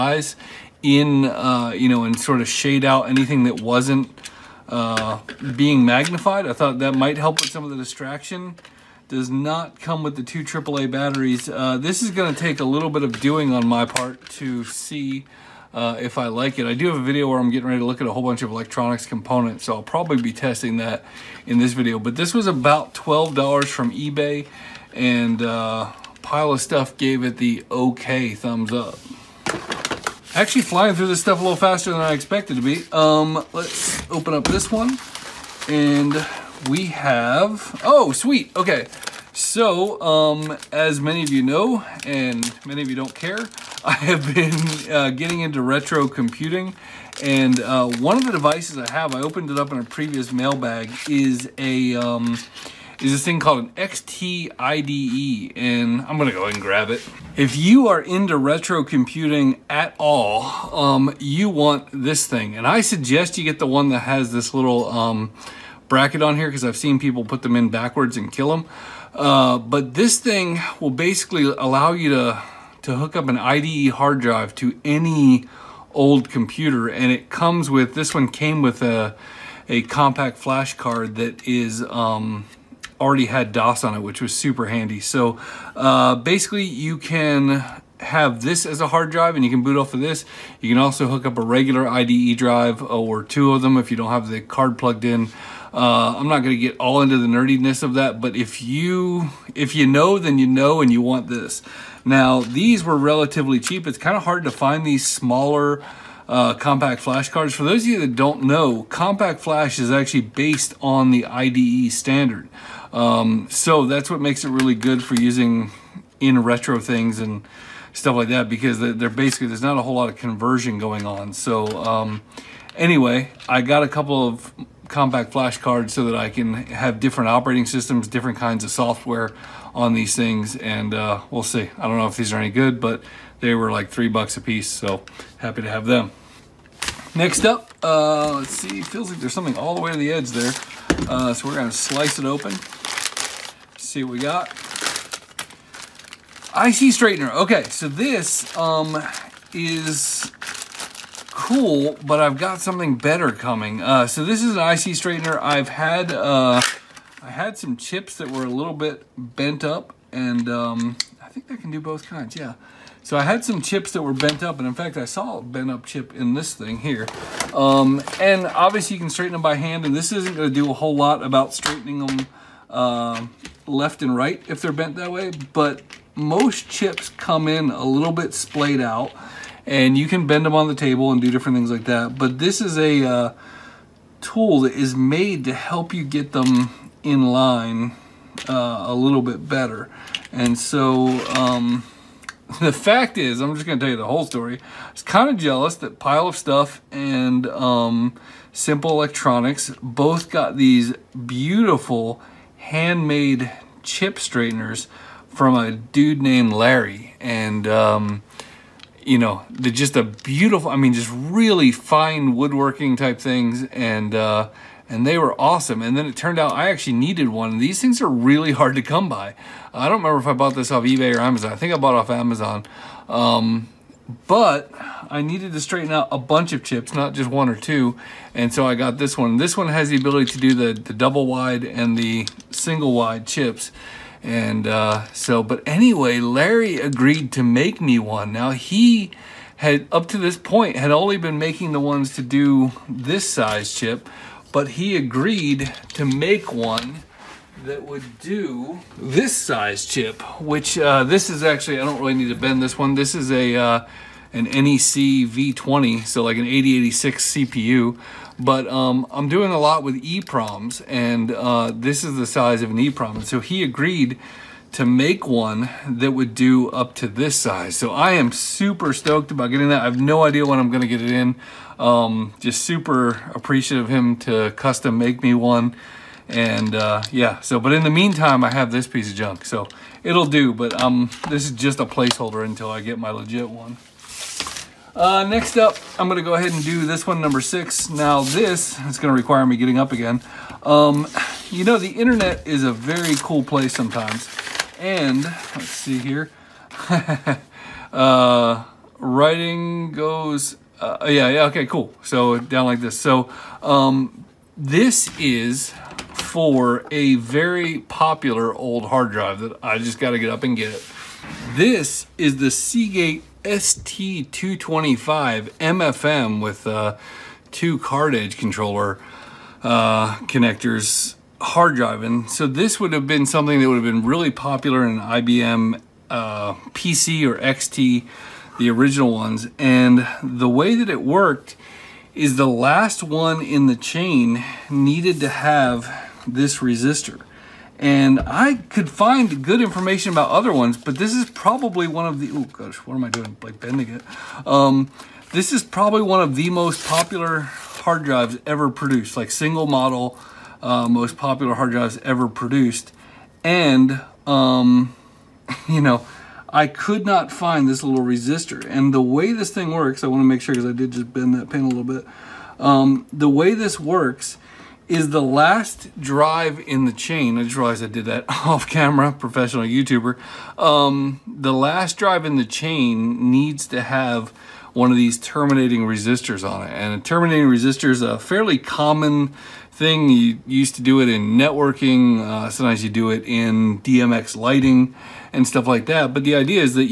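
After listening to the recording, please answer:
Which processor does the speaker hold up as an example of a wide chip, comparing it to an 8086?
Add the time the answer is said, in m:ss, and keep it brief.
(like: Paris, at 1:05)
NEC V20, at 4:14.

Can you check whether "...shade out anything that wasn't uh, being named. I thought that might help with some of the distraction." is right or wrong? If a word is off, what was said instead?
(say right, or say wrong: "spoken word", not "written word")
wrong: "magnified", not "named".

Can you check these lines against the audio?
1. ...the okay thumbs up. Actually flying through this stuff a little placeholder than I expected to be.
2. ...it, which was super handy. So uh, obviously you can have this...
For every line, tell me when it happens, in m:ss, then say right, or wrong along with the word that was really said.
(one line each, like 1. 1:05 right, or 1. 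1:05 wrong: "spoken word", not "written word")
1. 0:27 wrong: "faster", not "placeholder"
2. 1:23 wrong: "basically", not "obviously".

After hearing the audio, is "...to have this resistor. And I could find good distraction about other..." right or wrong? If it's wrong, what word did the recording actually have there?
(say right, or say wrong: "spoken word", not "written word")
wrong: "information", not "distraction".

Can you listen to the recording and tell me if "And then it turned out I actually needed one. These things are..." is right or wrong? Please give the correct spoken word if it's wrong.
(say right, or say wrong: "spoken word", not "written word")
right.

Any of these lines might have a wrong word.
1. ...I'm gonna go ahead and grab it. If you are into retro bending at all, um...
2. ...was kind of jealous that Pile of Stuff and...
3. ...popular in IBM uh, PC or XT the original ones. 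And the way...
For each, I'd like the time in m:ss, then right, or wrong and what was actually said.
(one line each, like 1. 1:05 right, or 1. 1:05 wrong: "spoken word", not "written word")
1. 0:56 wrong: "computing", not "bending"
2. 3:14 right
3. 5:24 right.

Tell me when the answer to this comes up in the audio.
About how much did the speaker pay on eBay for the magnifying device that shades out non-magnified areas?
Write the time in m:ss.
0:22.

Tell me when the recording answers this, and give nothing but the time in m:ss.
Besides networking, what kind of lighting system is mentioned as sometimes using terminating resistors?
6:23.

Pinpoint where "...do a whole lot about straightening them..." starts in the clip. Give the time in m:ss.
2:50.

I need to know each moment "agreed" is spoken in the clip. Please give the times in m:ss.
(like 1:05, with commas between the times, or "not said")
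3:56, 4:04, 4:23.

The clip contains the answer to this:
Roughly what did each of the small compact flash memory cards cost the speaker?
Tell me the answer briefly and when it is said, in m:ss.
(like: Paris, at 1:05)
3 bucks, at 2:13.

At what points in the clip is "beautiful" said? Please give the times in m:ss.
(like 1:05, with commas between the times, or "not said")
3:21, 3:30.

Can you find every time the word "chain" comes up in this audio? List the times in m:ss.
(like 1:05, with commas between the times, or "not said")
5:33, 6:06, 6:12.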